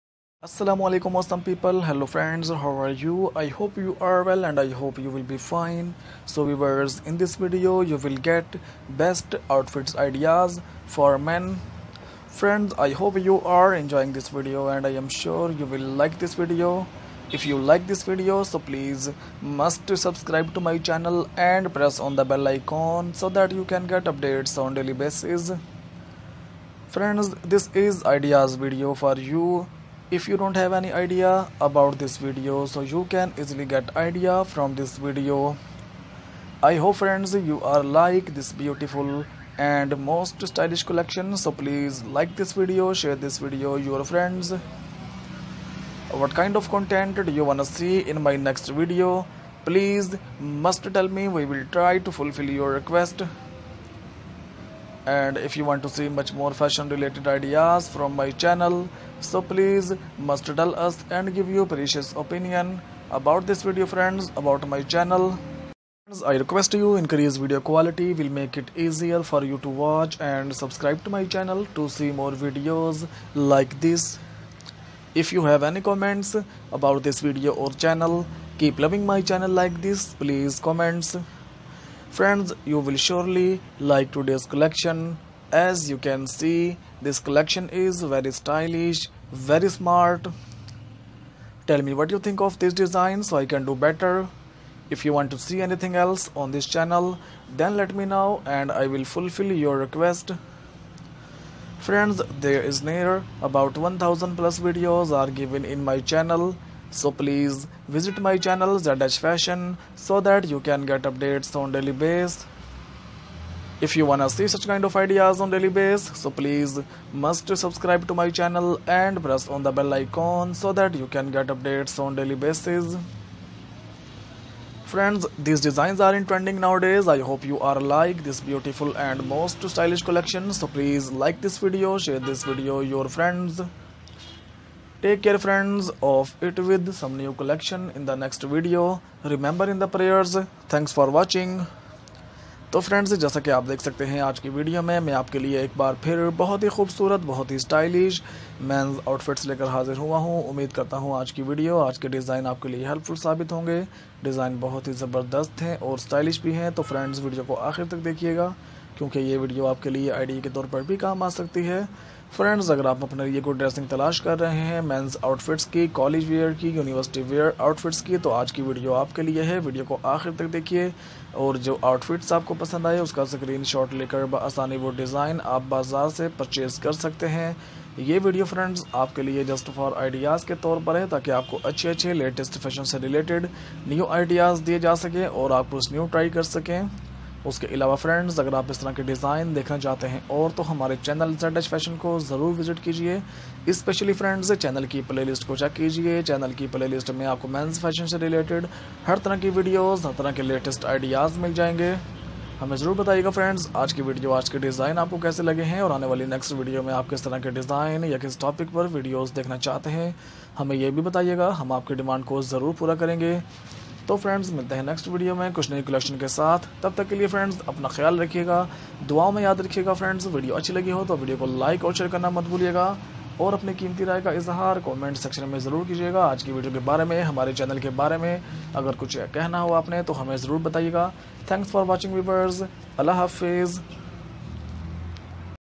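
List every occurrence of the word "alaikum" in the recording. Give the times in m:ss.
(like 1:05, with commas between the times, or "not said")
0:00.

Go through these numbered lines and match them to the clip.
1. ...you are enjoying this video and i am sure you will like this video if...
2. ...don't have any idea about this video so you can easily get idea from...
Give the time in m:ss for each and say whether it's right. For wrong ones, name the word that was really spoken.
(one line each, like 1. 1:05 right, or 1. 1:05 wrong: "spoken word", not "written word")
1. 0:13 right
2. 0:30 right.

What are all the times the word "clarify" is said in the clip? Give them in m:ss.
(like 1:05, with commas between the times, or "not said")
not said.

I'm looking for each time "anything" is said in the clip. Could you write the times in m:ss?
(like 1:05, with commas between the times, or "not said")
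1:35.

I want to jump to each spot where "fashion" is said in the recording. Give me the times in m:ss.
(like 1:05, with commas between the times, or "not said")
0:56, 1:49.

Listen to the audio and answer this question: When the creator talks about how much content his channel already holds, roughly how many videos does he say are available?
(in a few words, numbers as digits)
1000 plus.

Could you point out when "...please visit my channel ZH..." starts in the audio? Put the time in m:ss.
1:47.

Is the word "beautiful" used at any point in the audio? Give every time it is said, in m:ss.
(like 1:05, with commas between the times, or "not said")
0:38, 2:08.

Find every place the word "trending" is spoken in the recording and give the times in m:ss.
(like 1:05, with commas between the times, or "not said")
2:06.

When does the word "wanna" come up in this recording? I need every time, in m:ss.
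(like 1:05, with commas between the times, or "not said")
0:47, 1:54.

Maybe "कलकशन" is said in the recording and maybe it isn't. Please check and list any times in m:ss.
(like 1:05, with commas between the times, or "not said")
2:17, 3:35.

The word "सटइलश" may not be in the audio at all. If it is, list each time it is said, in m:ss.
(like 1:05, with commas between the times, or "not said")
2:27, 2:36.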